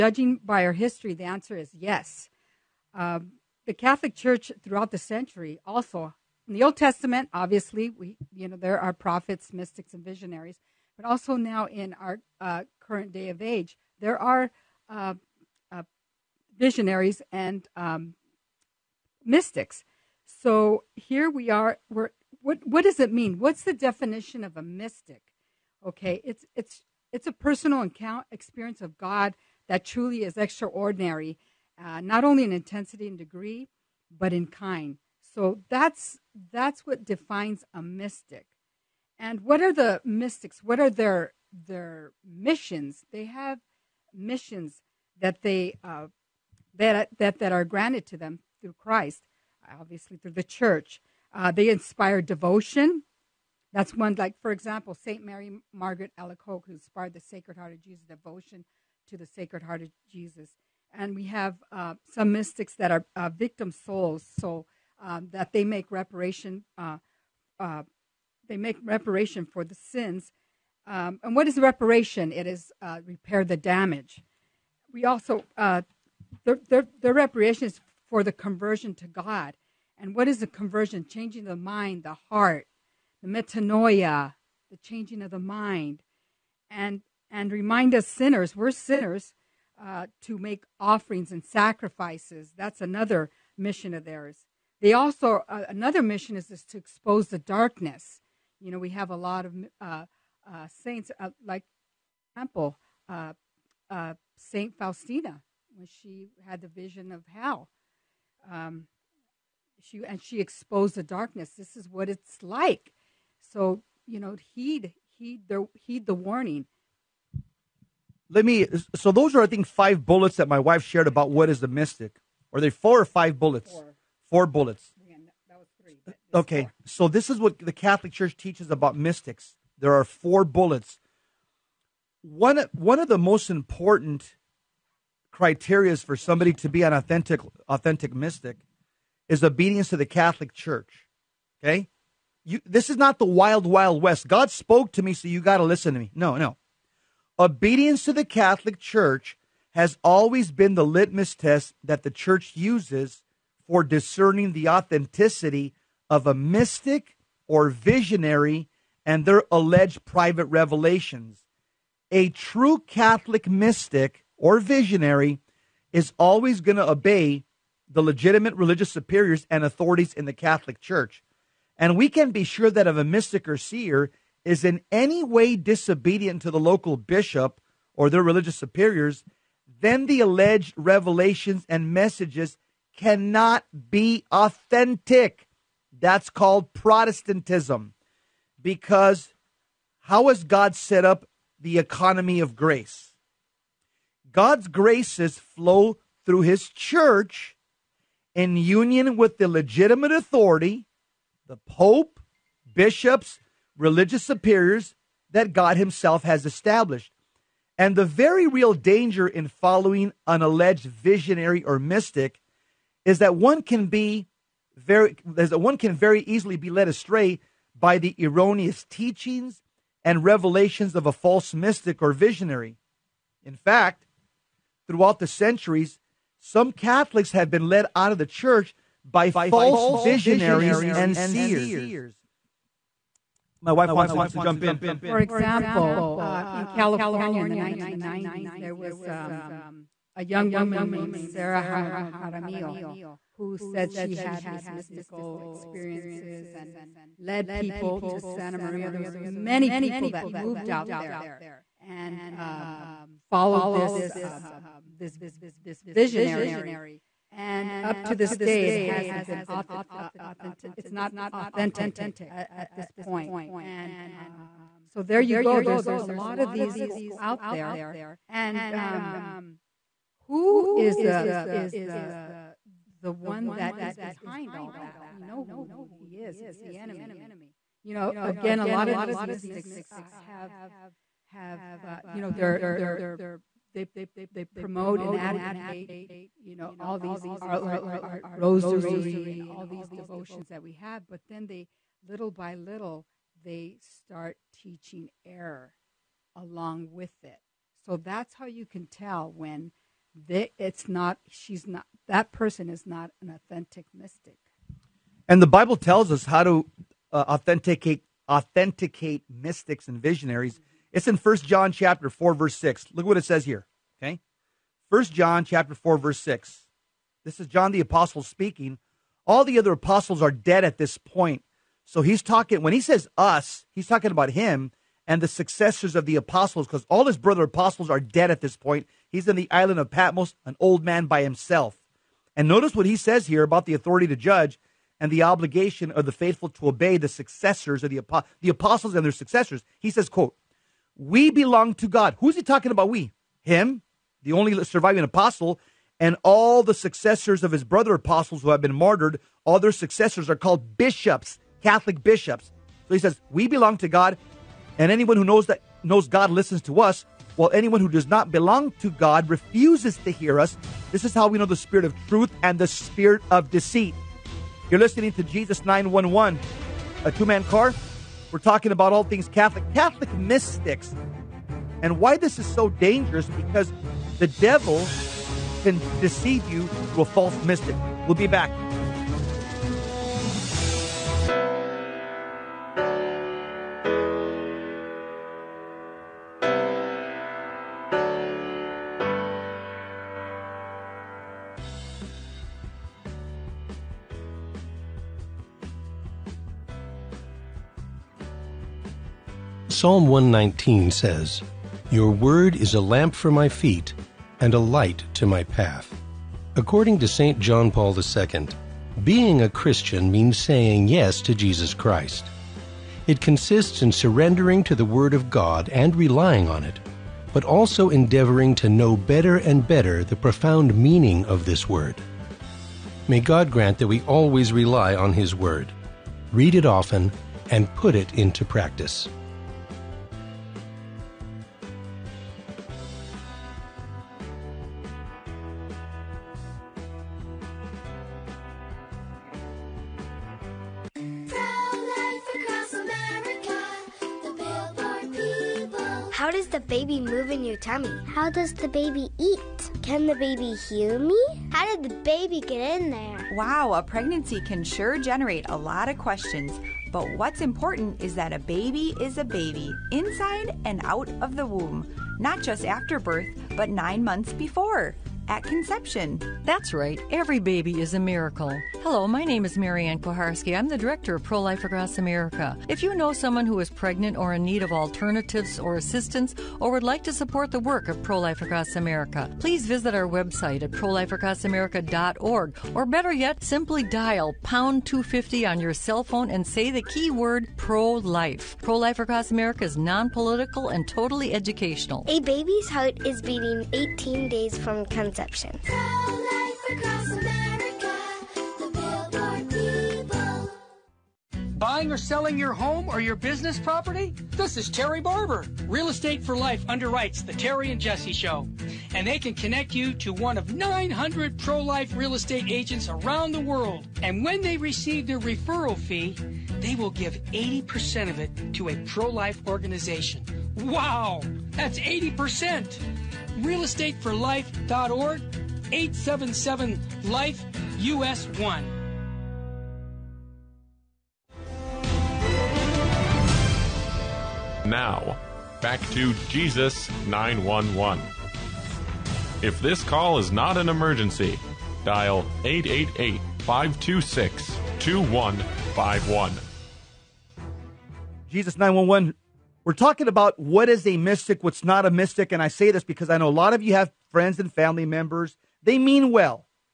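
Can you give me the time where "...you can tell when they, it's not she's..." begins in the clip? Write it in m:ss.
4:58.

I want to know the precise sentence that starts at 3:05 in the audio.
That's called Protestantism because how has God set up the economy of grace?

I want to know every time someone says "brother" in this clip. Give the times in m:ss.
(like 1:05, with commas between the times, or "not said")
5:27, 5:47.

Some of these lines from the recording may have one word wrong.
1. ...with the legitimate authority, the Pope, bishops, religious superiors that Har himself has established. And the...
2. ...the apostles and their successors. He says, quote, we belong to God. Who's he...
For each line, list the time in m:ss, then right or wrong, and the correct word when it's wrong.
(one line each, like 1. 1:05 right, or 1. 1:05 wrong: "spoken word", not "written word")
1. 3:19 wrong: "God", not "Har"
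2. 5:38 right.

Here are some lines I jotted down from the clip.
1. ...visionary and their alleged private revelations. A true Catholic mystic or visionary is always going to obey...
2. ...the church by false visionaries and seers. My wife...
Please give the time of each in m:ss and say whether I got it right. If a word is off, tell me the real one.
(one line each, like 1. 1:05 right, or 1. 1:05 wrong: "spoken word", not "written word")
1. 2:37 right
2. 3:48 right.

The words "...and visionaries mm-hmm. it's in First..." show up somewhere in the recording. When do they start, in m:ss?
5:09.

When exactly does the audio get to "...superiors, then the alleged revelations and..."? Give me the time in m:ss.
2:58.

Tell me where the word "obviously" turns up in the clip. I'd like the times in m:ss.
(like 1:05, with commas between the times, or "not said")
0:07, 0:49.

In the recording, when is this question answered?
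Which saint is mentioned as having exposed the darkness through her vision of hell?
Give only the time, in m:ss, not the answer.
1:44.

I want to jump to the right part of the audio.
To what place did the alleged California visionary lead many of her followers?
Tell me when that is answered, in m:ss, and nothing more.
4:08.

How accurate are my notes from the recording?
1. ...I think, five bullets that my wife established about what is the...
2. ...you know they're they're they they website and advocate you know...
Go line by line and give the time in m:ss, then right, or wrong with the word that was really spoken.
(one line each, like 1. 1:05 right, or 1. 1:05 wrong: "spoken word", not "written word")
1. 1:59 wrong: "shared", not "established"
2. 4:42 wrong: "promote", not "website".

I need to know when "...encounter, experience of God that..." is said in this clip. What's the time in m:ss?
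0:27.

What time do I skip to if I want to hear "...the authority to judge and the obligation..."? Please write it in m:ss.
5:33.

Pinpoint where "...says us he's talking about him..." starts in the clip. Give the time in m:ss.
5:22.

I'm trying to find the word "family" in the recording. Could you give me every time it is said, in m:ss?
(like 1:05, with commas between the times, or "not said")
9:14.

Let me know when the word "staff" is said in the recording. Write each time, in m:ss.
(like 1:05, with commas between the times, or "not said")
not said.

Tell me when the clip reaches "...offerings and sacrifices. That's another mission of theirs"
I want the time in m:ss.
1:30.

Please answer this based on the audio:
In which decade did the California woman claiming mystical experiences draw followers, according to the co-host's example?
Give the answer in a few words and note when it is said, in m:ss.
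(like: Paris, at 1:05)
1990s, at 3:57.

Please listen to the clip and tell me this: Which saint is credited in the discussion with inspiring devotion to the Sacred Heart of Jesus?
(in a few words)
Saint Mary Margaret Alacoque.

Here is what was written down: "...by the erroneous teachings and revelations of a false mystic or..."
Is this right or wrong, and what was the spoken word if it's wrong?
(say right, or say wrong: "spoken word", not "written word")
right.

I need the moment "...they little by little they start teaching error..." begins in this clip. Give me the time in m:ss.
4:51.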